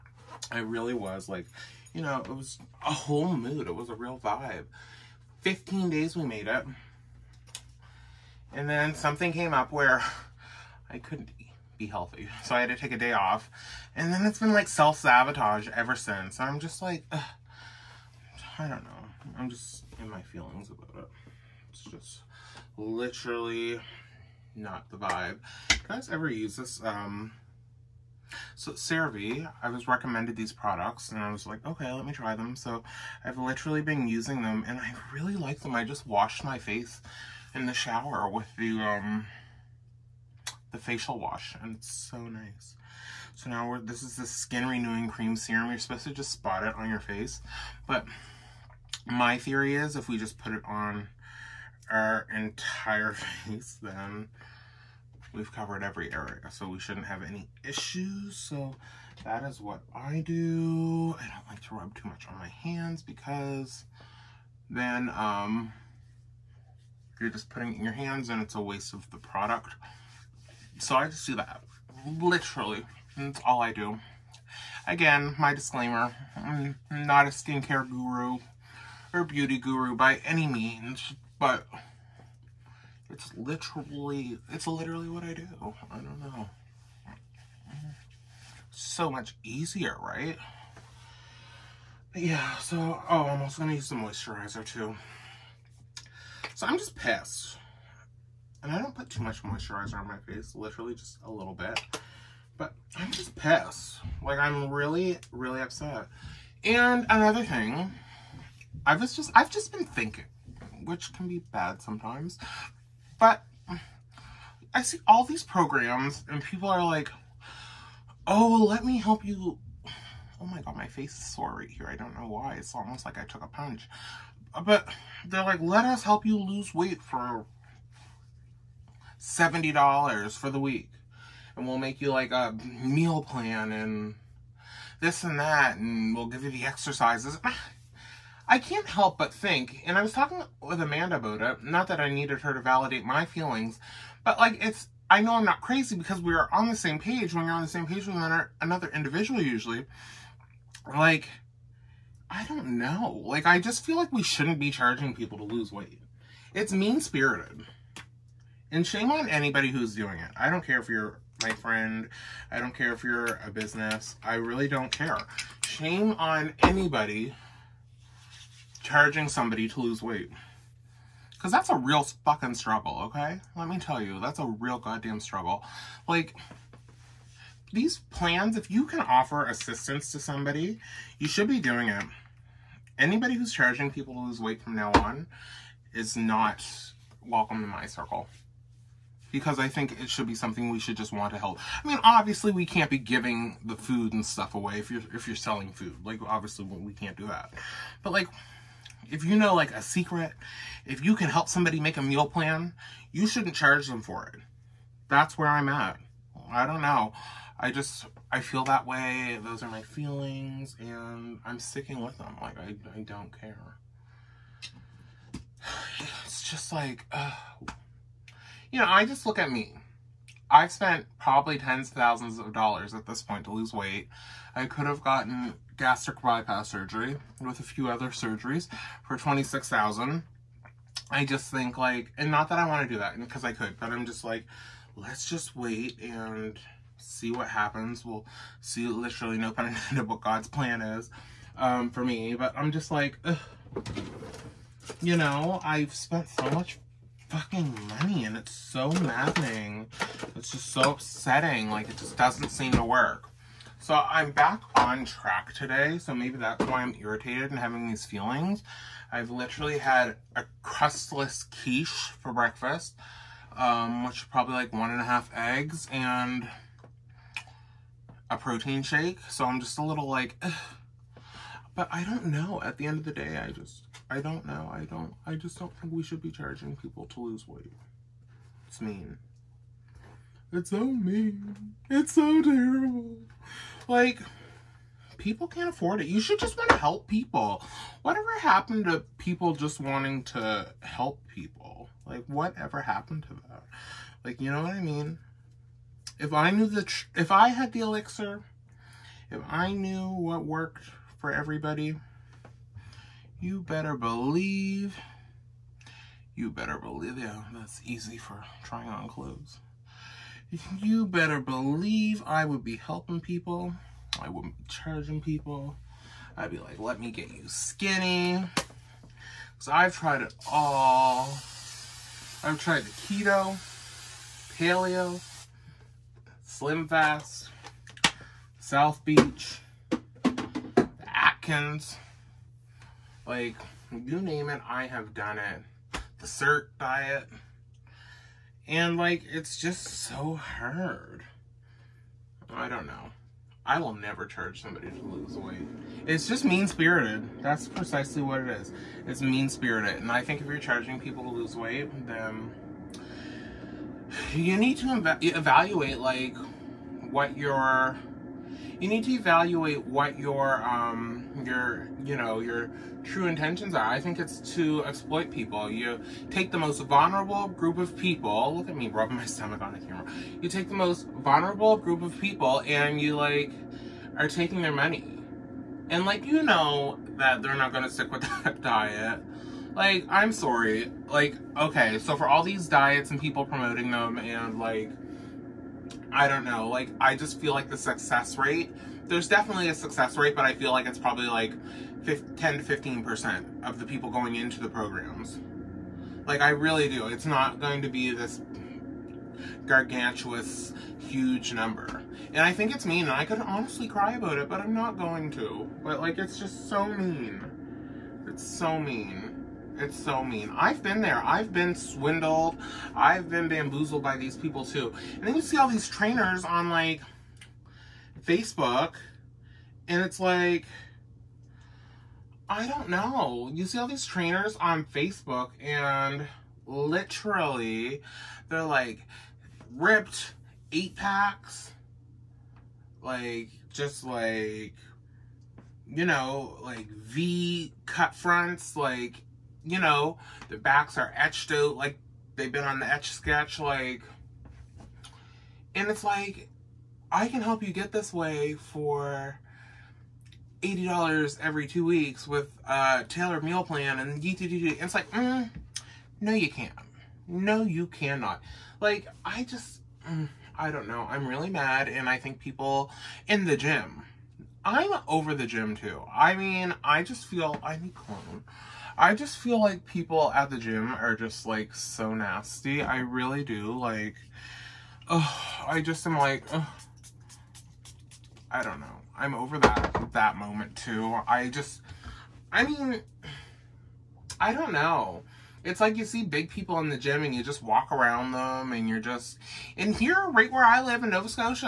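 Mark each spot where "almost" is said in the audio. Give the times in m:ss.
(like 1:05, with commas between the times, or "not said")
2:02.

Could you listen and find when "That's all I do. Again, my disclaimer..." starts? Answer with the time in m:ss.
1:13.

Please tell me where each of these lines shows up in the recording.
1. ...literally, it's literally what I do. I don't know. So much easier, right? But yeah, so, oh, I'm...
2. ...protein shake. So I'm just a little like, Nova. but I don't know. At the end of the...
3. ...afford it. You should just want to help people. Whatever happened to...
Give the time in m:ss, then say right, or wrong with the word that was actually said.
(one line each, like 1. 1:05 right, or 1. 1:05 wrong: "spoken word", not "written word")
1. 1:23 right
2. 4:28 wrong: "Ugh", not "Nova"
3. 4:45 right.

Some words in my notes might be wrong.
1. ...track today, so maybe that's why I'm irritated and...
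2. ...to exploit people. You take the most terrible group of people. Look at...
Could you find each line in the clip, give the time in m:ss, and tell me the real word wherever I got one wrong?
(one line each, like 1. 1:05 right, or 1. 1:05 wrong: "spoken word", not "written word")
1. 4:15 right
2. 6:04 wrong: "vulnerable", not "terrible".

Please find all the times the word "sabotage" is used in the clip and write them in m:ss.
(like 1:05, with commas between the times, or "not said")
0:14.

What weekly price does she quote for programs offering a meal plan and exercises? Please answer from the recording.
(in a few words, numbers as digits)
$70.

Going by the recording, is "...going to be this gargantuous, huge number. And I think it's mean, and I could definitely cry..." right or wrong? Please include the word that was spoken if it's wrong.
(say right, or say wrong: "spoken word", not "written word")
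wrong: "honestly", not "definitely".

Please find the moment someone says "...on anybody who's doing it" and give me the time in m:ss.
2:39.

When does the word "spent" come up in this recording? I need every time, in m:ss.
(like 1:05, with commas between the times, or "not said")
3:40, 4:05.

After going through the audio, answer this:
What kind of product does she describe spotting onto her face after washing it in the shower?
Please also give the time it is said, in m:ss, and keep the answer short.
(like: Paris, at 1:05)
skin renewing cream serum, at 0:44.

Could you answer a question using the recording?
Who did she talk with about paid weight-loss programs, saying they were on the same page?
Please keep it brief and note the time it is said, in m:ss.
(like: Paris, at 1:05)
Amanda, at 2:20.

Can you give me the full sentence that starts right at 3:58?
We'll see literally no pun intended what God's plan is um, for me.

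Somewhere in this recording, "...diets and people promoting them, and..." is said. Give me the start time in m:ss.
6:22.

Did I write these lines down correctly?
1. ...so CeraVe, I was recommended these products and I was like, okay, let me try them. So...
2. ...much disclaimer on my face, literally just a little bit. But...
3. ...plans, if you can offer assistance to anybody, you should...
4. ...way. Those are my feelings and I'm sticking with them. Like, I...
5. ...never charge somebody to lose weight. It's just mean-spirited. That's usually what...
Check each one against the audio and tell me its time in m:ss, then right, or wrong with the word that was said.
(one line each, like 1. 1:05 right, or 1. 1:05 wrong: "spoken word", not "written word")
1. 0:28 right
2. 1:39 wrong: "moisturizer", not "disclaimer"
3. 2:58 wrong: "somebody", not "anybody"
4. 3:28 right
5. 5:43 wrong: "precisely", not "usually".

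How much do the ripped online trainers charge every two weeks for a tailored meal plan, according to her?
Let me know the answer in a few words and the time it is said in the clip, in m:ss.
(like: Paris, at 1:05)
$80, at 7:30.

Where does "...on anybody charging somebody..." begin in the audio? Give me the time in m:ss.
2:46.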